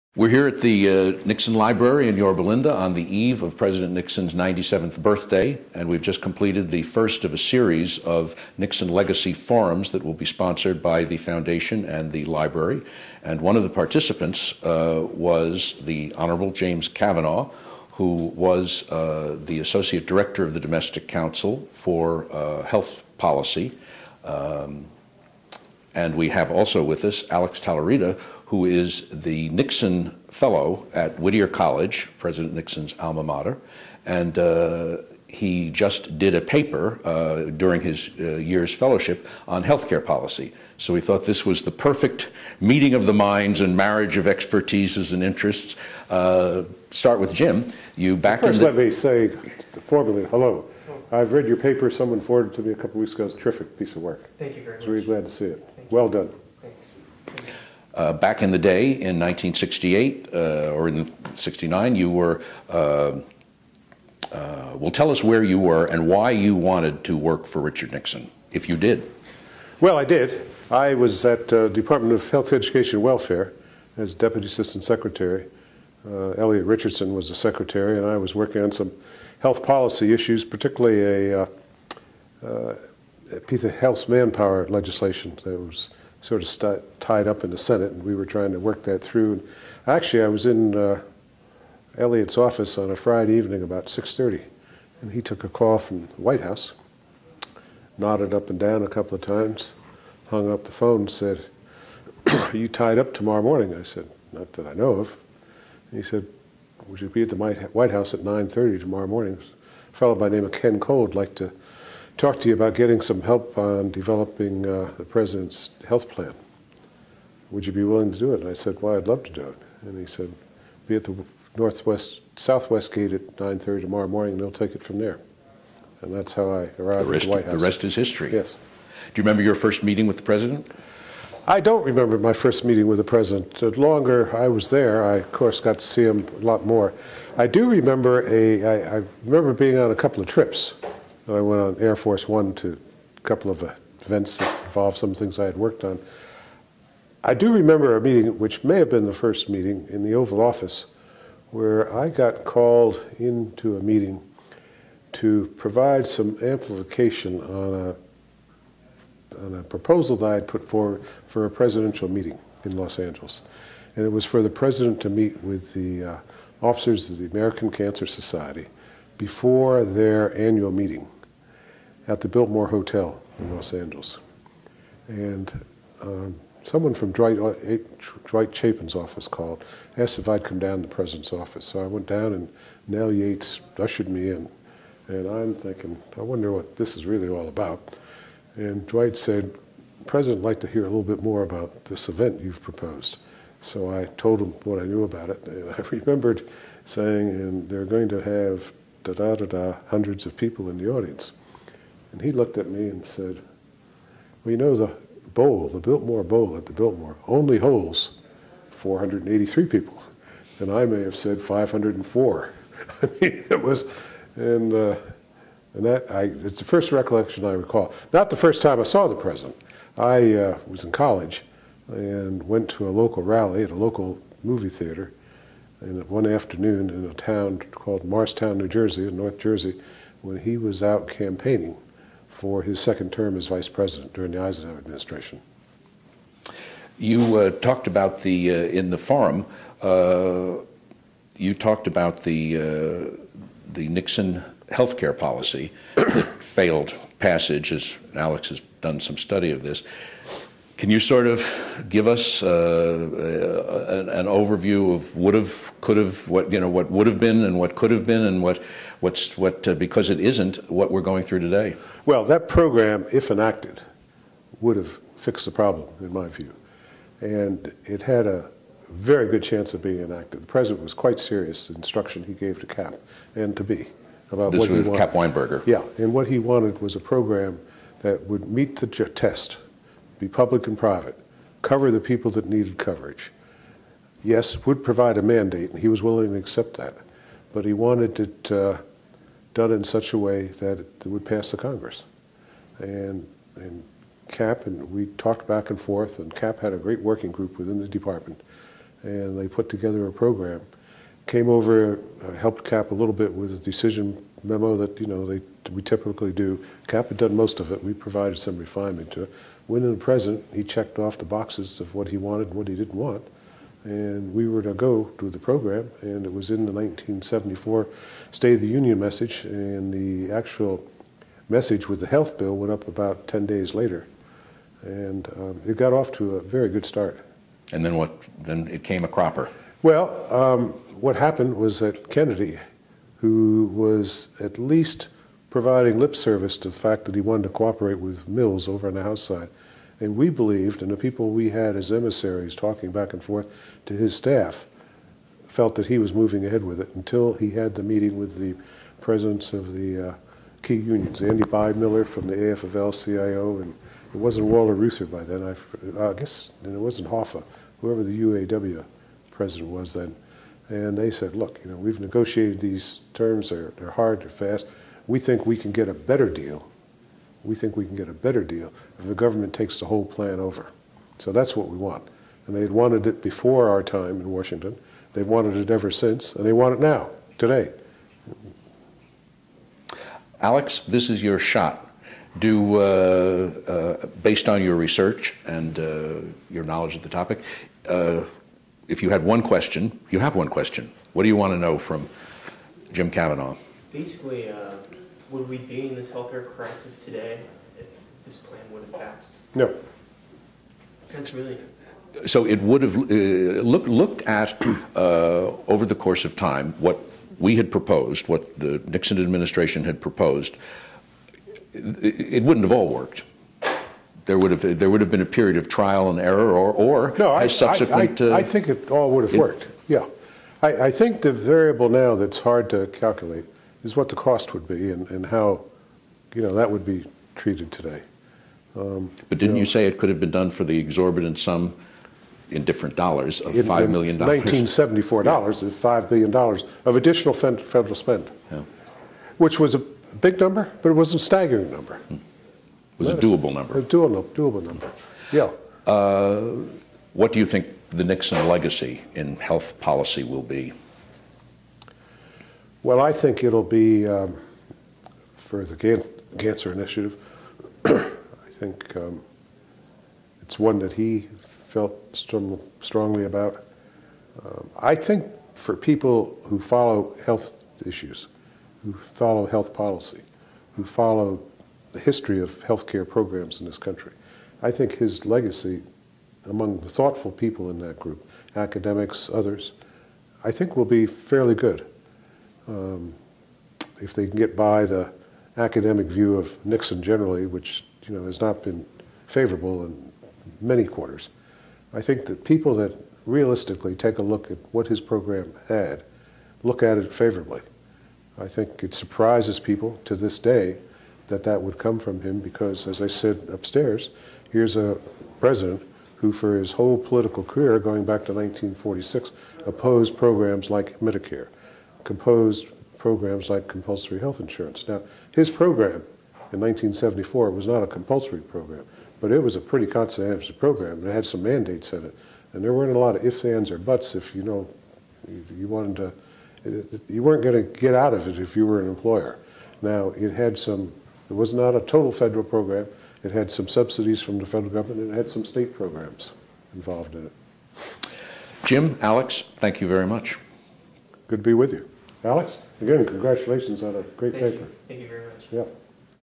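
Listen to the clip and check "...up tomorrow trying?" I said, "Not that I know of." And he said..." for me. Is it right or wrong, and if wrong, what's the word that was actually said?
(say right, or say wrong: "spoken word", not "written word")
wrong: "morning", not "trying".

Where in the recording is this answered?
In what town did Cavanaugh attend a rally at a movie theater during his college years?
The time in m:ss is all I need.
3:48.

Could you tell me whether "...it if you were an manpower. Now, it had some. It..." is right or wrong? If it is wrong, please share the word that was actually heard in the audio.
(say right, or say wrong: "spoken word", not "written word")
wrong: "employer", not "manpower".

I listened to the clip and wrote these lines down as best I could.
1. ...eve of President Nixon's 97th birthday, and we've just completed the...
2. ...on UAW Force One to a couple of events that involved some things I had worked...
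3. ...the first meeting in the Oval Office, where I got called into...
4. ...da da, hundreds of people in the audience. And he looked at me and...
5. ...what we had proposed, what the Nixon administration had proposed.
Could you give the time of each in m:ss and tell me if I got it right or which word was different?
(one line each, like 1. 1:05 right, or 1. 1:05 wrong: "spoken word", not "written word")
1. 0:03 right
2. 2:21 wrong: "Air", not "UAW"
3. 2:29 right
4. 3:19 right
5. 6:46 right.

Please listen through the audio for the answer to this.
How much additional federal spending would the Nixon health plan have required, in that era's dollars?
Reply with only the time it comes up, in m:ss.
7:15.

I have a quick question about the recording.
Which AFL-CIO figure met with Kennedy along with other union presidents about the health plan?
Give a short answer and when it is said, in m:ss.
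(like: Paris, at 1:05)
Andy Biemiller, at 5:51.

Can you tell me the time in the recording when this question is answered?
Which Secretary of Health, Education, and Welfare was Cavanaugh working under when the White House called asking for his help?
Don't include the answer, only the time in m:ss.
1:16.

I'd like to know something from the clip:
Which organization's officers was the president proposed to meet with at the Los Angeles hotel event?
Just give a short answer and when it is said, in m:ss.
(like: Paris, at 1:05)
American Cancer Society, at 2:47.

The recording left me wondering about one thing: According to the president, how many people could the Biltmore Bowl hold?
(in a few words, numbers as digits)
483.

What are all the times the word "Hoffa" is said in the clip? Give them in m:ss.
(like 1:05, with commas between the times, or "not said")
5:57.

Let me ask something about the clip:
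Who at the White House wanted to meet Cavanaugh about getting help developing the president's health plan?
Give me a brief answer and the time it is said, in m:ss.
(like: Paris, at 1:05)
Ken Cole, at 1:50.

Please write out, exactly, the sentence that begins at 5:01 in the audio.
Came over, uh, helped CAP a little bit with a decision memo that, you know, they we typically do.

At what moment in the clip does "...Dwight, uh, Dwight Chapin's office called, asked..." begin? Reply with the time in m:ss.
2:57.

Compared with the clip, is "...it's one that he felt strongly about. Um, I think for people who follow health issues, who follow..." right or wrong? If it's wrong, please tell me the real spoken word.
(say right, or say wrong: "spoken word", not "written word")
right.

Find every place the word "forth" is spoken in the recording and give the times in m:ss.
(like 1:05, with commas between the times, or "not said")
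4:55, 5:43.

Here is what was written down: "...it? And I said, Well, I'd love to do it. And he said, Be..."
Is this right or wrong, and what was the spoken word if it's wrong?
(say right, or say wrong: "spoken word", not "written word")
right.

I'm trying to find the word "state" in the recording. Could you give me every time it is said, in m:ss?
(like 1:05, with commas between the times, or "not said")
5:18, 8:55.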